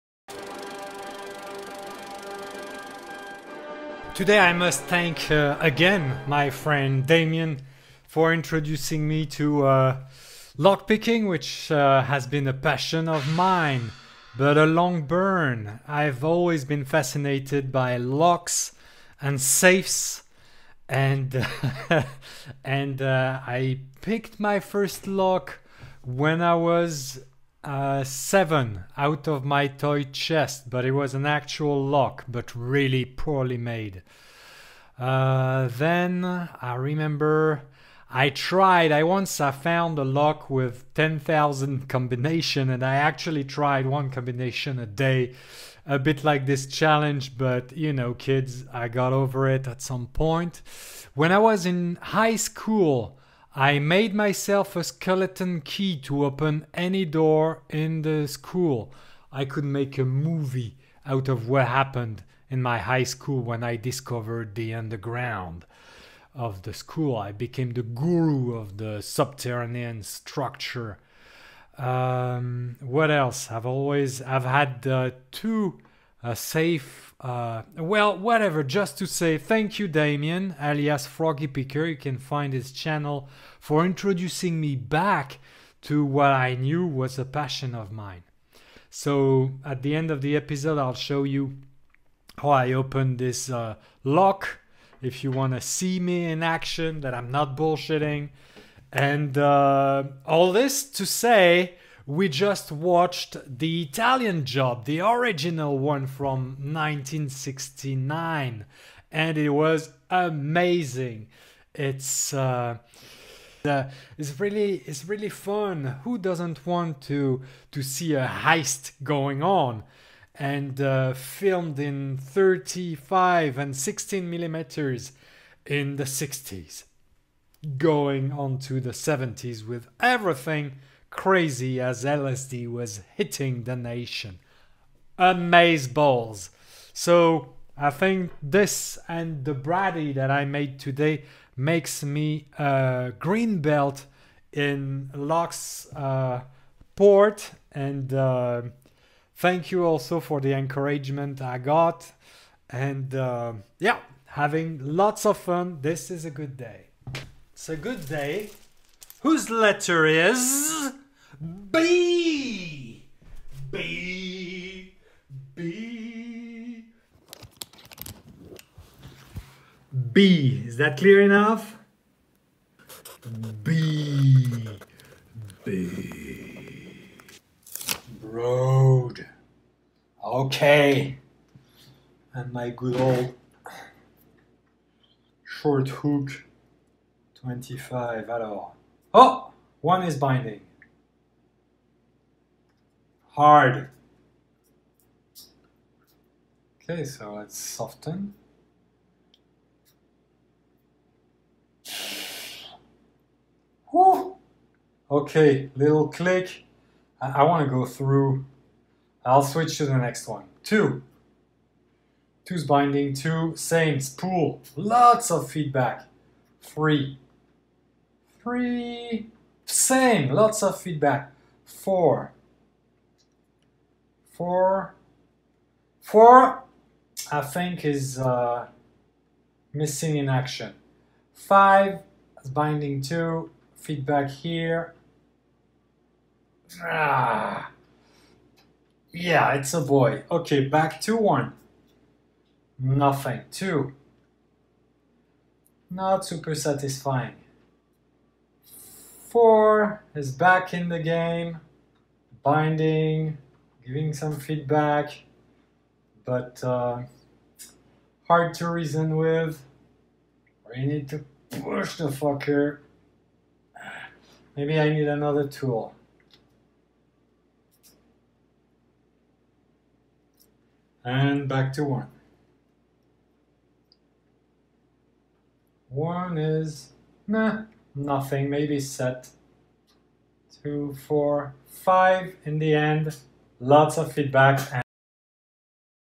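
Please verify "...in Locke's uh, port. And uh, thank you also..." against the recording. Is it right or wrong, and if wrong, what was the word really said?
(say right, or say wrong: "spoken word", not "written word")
right.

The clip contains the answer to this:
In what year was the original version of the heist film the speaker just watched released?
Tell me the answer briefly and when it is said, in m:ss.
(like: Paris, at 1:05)
1969, at 1:46.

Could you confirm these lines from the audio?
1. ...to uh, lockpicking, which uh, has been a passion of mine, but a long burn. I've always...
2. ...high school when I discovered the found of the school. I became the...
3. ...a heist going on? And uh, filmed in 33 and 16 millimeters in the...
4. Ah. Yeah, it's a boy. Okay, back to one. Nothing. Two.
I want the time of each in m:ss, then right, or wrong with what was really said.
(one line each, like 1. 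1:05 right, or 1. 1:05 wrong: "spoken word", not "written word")
1. 0:09 right
2. 1:02 wrong: "underground", not "found"
3. 1:58 wrong: "35", not "33"
4. 3:56 right.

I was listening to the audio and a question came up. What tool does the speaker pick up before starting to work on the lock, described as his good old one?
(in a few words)
short hook 25.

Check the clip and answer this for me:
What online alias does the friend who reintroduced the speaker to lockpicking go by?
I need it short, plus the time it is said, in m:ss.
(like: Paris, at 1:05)
Froggy Picker, at 1:21.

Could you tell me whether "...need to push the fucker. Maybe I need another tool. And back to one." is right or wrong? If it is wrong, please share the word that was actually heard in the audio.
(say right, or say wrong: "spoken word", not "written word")
right.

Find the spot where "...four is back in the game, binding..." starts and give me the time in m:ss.
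4:09.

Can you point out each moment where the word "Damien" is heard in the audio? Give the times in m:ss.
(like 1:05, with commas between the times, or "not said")
0:07, 1:19.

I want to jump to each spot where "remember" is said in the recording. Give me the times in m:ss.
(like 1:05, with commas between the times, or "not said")
0:36.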